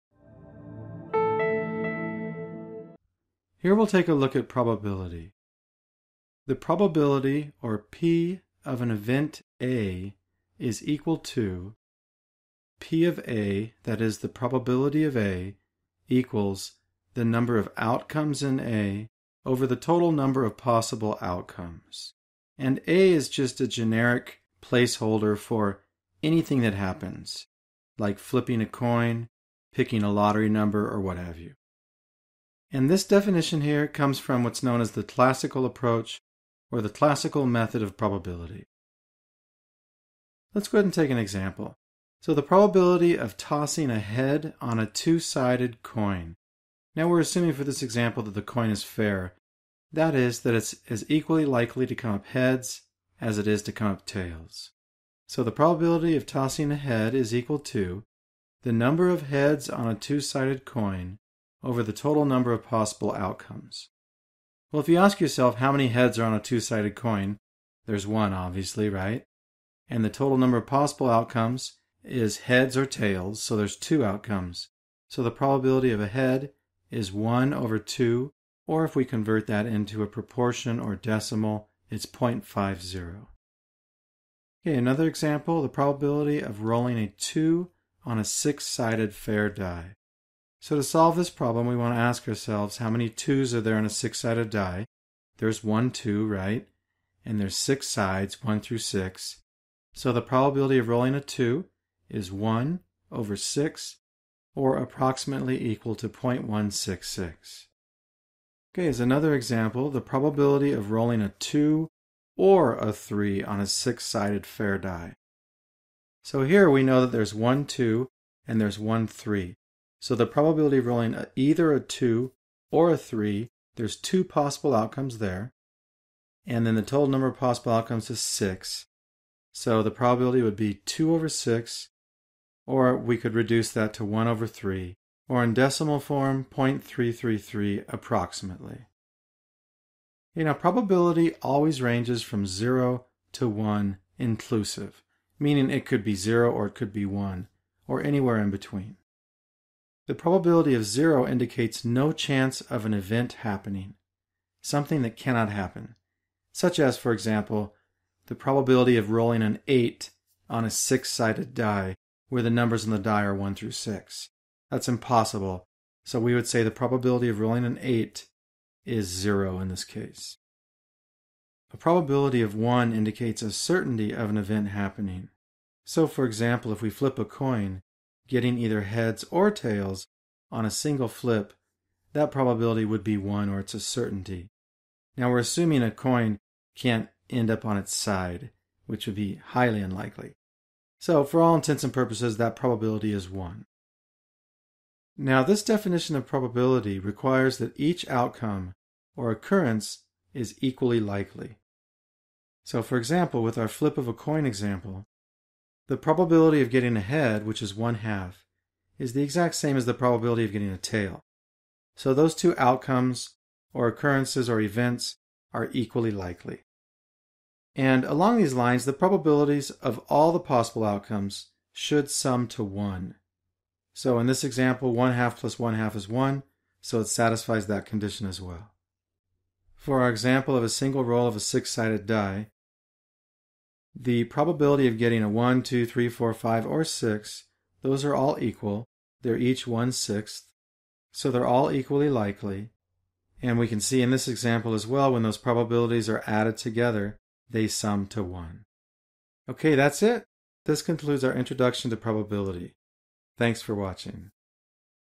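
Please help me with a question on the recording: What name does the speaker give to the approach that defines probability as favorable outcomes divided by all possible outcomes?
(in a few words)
classical approach.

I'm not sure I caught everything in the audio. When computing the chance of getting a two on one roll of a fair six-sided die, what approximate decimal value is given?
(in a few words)
0.166.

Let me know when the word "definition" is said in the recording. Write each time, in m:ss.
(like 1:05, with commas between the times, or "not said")
0:33, 3:15.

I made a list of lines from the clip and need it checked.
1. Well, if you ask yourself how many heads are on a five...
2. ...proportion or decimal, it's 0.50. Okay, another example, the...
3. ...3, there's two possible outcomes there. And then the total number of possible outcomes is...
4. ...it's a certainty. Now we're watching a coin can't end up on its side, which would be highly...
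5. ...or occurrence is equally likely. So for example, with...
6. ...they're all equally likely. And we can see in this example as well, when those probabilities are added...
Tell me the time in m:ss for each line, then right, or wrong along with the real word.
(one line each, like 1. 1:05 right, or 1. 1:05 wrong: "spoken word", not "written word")
1. 1:04 wrong: "two", not "five"
2. 1:20 right
3. 2:02 right
4. 3:03 wrong: "assuming", not "watching"
5. 3:19 right
6. 4:01 right.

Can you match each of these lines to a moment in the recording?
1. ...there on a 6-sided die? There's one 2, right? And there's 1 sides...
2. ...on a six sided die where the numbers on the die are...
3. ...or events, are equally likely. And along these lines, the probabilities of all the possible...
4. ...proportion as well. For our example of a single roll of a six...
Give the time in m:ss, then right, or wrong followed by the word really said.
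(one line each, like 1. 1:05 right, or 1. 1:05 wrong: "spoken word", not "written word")
1. 1:33 wrong: "6", not "1"
2. 2:40 right
3. 3:34 right
4. 3:47 wrong: "condition", not "proportion".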